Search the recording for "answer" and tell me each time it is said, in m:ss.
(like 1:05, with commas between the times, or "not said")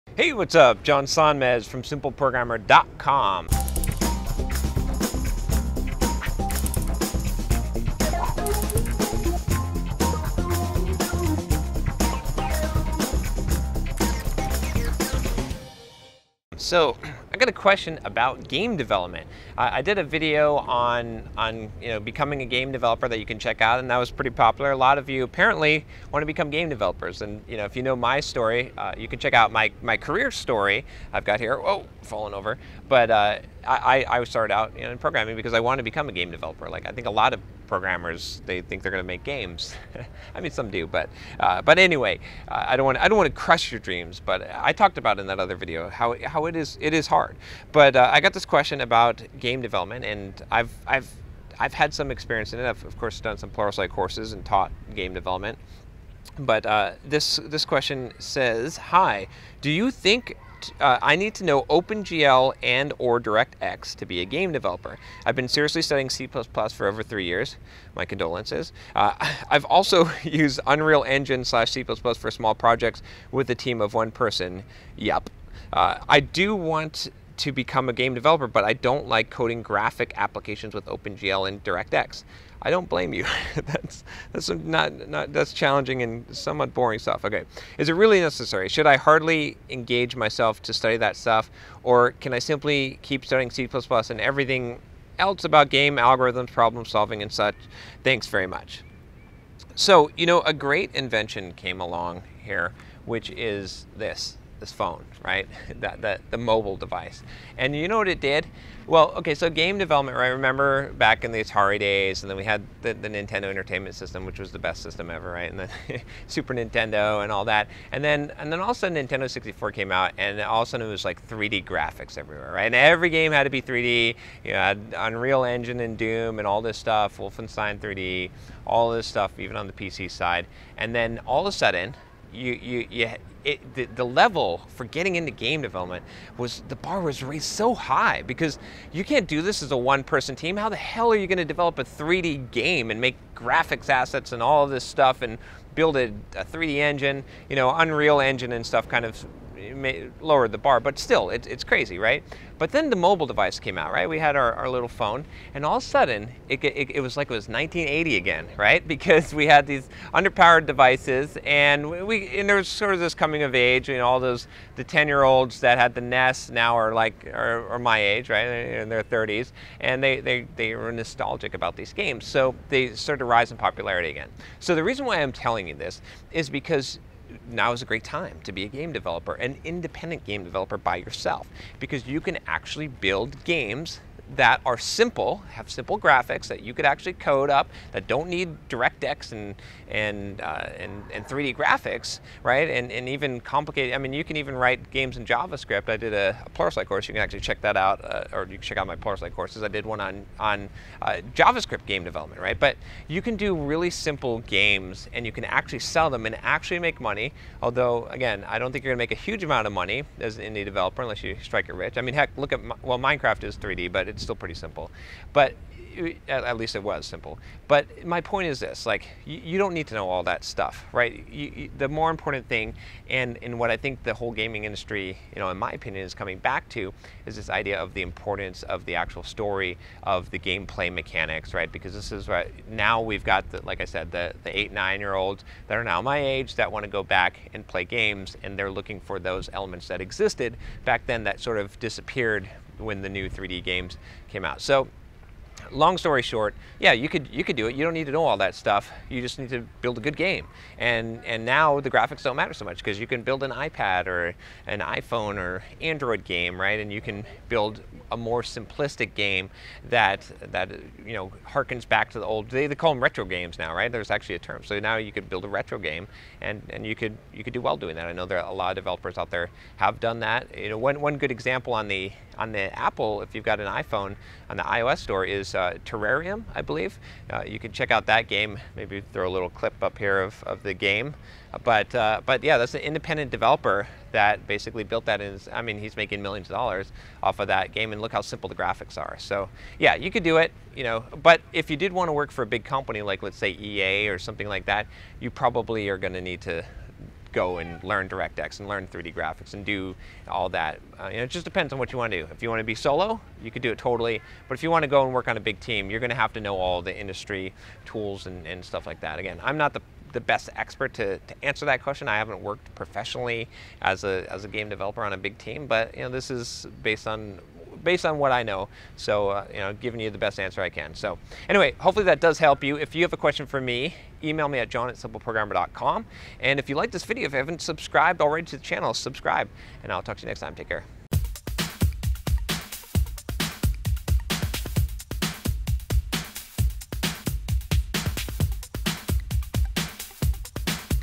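5:11, 5:20.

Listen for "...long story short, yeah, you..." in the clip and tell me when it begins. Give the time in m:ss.
4:05.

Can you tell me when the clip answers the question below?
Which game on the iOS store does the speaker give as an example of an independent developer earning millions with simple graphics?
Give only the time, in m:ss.
4:35.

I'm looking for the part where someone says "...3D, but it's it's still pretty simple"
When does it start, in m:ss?
3:33.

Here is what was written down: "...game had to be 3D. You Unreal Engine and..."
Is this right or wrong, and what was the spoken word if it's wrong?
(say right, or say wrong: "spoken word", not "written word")
right.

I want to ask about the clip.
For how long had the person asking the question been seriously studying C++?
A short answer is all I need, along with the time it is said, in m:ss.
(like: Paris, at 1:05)
3 years, at 1:07.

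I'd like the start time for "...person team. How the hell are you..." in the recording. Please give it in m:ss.
2:20.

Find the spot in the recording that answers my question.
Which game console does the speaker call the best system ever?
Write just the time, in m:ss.
1:53.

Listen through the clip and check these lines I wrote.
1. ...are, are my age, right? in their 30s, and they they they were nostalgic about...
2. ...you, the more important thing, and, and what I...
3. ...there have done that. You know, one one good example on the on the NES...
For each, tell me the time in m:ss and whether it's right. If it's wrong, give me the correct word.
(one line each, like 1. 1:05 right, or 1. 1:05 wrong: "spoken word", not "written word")
1. 2:47 right
2. 3:41 right
3. 4:29 wrong: "Apple", not "NES".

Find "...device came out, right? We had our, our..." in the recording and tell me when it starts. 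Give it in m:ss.
2:33.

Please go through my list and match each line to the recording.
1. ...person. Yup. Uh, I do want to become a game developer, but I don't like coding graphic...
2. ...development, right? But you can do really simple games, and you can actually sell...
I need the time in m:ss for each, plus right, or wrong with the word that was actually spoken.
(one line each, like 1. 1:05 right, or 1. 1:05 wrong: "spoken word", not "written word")
1. 1:14 right
2. 3:22 right.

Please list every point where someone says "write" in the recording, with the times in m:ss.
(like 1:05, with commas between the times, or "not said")
3:14.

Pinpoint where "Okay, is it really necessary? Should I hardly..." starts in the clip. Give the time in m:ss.
1:27.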